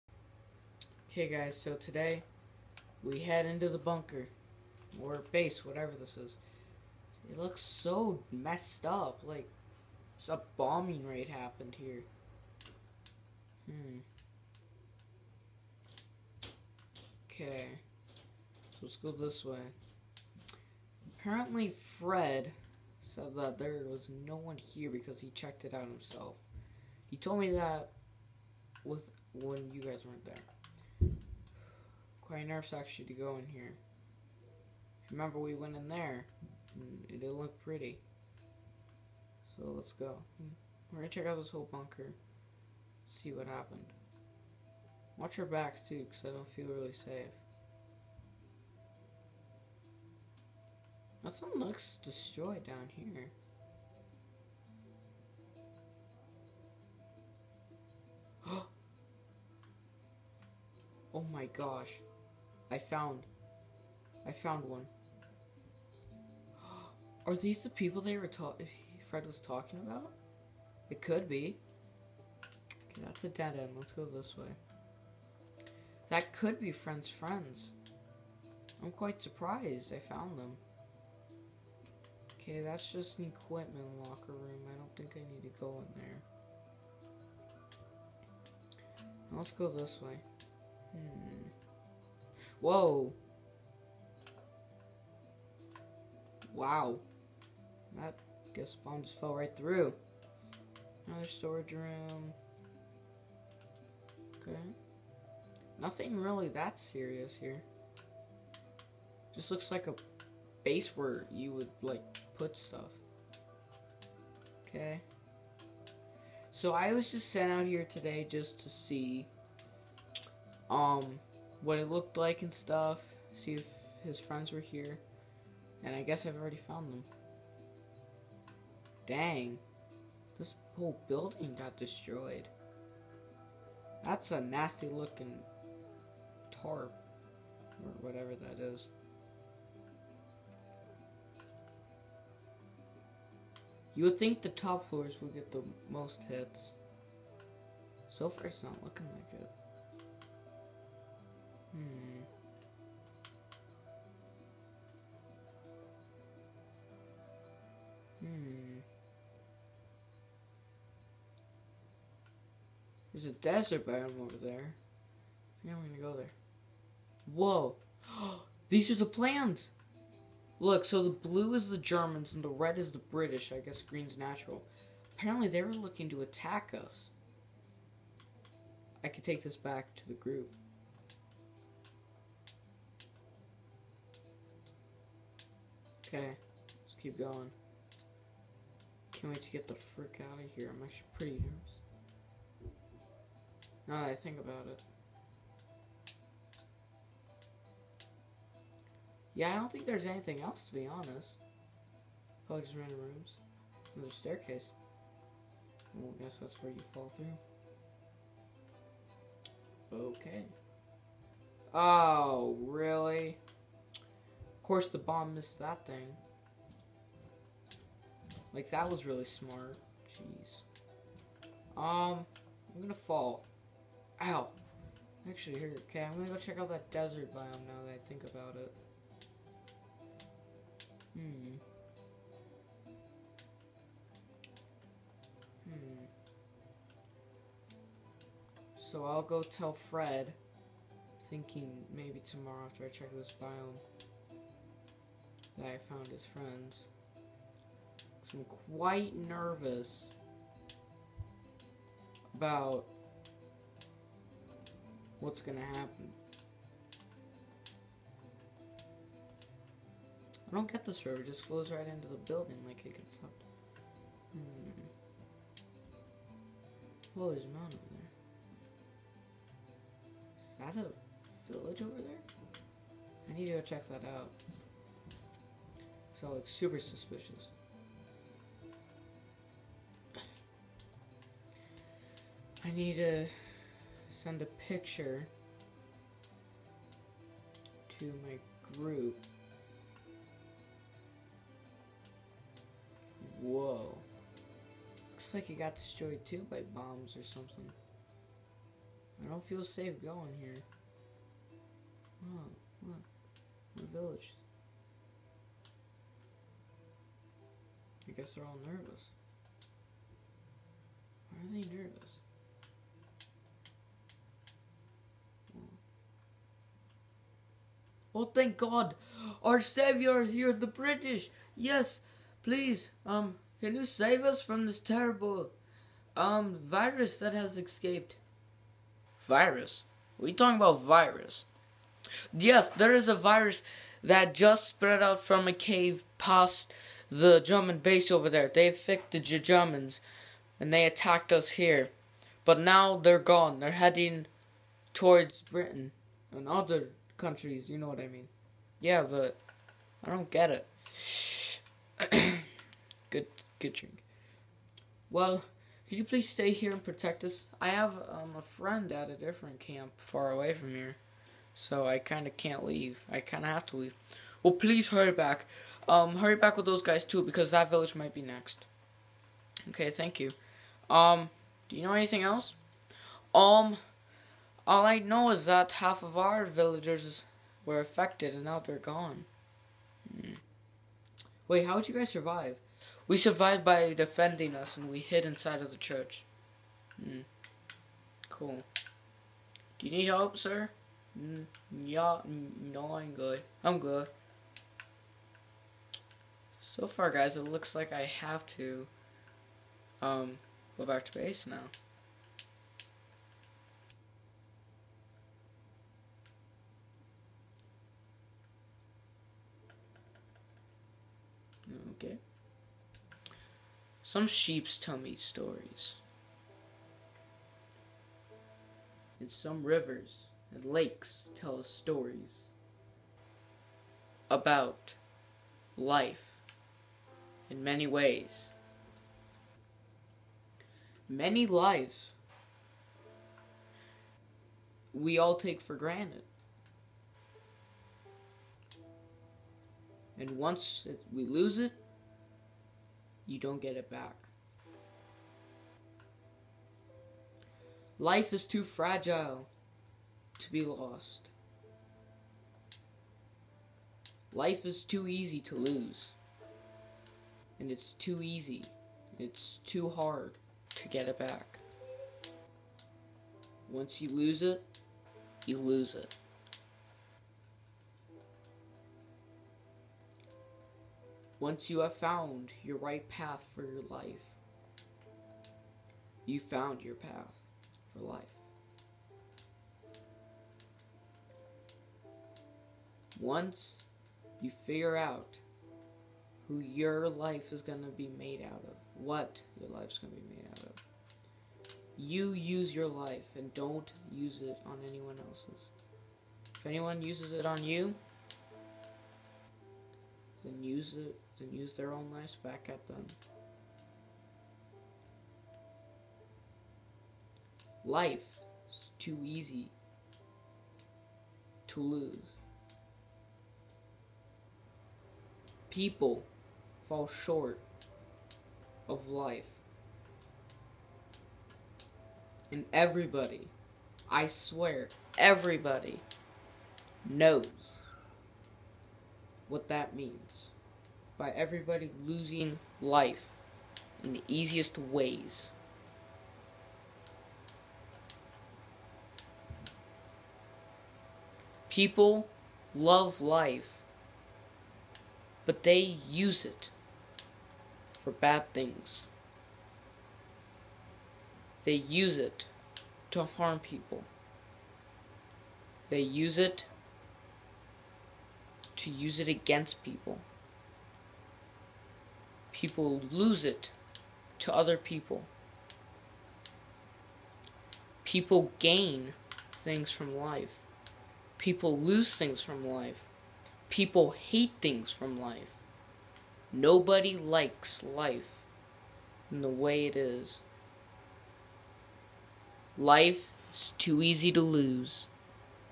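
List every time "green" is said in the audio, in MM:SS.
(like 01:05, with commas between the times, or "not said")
02:53.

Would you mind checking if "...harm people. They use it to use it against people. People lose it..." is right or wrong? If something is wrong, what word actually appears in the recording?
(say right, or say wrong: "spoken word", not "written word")
right.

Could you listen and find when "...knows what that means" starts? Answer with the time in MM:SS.
08:47.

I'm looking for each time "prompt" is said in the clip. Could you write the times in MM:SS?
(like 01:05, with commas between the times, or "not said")
not said.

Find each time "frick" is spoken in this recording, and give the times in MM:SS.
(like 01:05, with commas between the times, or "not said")
03:09.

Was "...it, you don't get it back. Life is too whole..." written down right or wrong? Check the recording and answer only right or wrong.
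wrong.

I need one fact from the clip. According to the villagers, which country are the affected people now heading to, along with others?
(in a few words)
Britain.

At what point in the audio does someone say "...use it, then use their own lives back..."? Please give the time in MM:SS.
08:20.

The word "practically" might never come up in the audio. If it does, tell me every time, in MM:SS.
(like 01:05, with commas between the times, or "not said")
not said.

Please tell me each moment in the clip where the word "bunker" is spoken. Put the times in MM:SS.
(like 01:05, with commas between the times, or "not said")
00:03, 00:41.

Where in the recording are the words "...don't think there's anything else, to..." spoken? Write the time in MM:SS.
03:19.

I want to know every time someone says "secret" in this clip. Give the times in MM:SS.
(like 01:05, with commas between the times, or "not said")
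not said.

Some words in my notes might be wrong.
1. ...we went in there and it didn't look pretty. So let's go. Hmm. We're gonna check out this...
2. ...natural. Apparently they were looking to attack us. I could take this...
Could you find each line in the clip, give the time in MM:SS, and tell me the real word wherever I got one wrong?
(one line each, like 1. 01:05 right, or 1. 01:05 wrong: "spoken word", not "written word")
1. 00:35 right
2. 02:54 right.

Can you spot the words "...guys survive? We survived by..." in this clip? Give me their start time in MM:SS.
06:21.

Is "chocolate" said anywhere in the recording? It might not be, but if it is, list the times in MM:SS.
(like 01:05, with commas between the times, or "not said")
not said.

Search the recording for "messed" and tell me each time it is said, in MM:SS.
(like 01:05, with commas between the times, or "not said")
00:08.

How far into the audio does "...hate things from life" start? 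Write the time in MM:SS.
09:34.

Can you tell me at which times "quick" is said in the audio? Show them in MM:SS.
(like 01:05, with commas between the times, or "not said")
not said.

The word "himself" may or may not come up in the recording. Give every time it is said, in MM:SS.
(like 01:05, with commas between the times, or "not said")
00:25.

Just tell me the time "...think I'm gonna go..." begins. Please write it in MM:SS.
02:45.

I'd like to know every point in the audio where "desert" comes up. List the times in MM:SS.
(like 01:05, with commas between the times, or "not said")
02:43, 03:46.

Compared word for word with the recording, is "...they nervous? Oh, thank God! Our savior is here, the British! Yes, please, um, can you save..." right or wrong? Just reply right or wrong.
right.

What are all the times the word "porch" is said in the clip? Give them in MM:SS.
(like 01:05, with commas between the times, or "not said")
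not said.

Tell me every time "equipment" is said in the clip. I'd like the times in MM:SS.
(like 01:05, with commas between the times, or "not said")
01:23.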